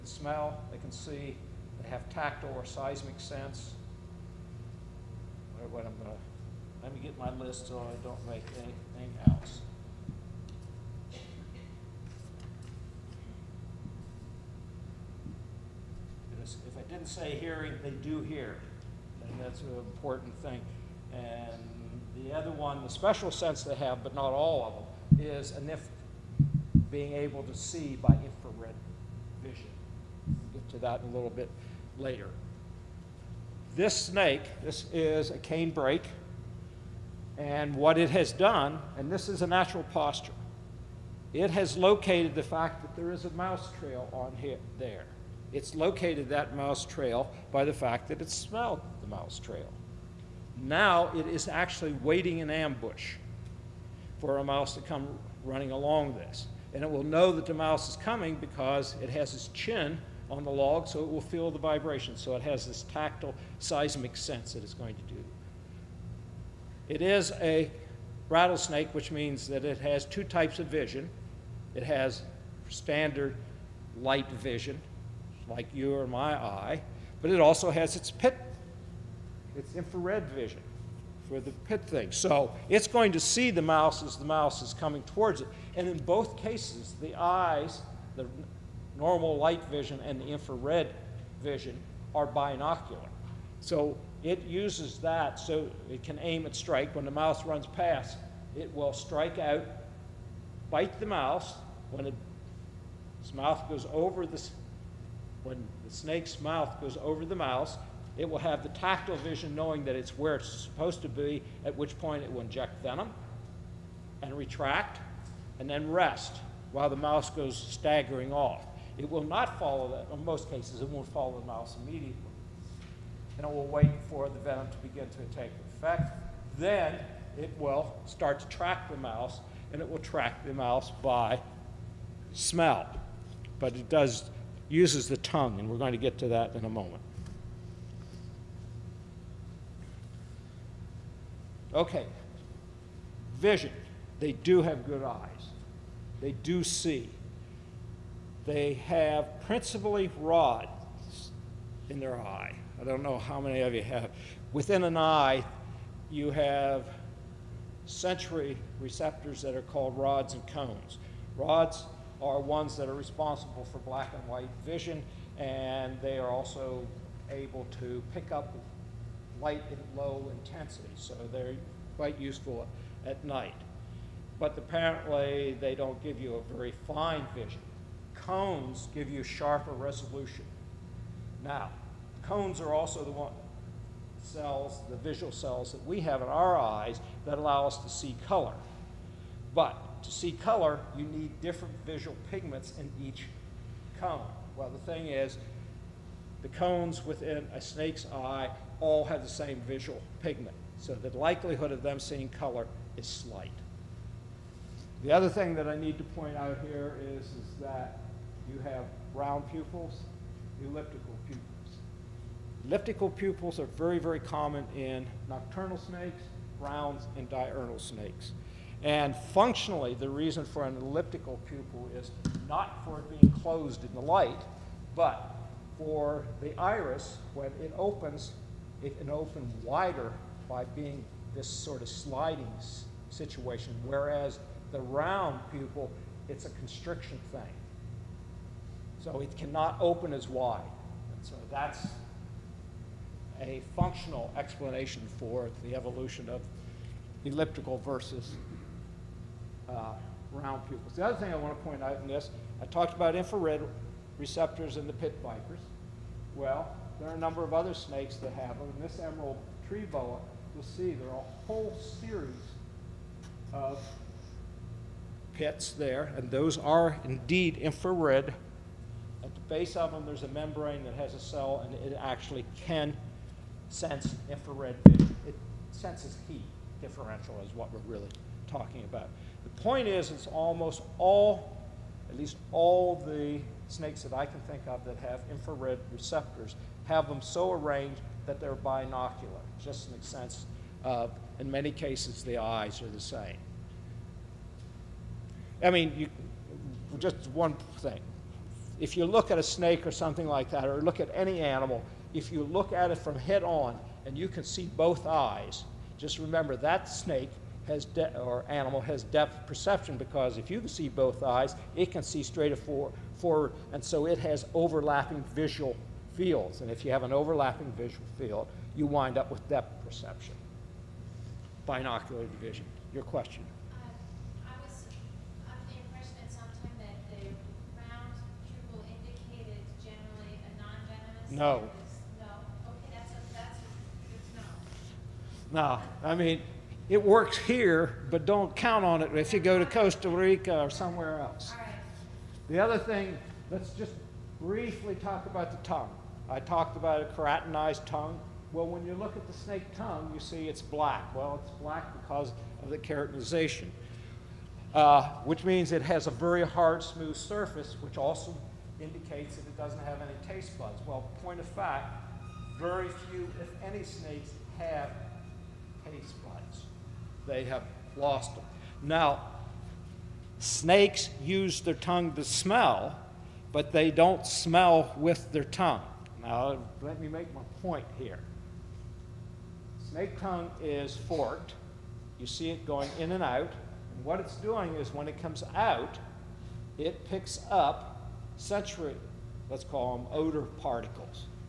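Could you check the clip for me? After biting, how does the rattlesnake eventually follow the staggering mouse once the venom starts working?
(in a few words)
by smell.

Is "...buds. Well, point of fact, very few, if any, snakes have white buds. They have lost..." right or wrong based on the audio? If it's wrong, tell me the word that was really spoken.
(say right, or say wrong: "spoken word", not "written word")
wrong: "taste", not "white".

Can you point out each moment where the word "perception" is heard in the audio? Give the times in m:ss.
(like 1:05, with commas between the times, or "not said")
5:09, 5:19.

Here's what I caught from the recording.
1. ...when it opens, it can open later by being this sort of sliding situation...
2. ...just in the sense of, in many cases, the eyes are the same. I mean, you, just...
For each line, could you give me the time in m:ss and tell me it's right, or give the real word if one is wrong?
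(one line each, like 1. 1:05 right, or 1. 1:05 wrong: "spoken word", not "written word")
1. 3:47 wrong: "wider", not "later"
2. 4:49 right.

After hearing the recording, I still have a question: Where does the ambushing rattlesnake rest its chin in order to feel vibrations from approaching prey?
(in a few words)
on the log.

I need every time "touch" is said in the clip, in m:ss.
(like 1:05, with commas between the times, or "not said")
not said.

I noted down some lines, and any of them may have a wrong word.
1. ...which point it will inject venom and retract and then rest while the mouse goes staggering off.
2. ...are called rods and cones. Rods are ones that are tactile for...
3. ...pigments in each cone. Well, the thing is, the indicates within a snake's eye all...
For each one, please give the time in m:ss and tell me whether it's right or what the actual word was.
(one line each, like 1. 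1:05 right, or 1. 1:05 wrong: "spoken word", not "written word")
1. 1:51 right
2. 2:39 wrong: "responsible", not "tactile"
3. 3:12 wrong: "cones", not "indicates".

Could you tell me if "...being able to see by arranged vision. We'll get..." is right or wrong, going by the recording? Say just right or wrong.
wrong.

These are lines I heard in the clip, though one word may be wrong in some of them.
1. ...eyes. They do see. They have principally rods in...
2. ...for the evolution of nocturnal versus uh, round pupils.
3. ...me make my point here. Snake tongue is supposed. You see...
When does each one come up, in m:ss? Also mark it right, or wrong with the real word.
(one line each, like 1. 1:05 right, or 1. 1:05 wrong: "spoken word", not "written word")
1. 2:25 right
2. 4:05 wrong: "elliptical", not "nocturnal"
3. 6:16 wrong: "forked", not "supposed".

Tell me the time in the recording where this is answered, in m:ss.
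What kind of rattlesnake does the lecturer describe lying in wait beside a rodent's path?
0:35.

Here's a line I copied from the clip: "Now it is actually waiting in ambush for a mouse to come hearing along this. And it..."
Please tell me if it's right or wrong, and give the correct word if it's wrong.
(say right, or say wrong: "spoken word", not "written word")
wrong: "running", not "hearing".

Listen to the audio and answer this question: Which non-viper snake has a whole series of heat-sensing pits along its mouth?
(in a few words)
emerald tree boa.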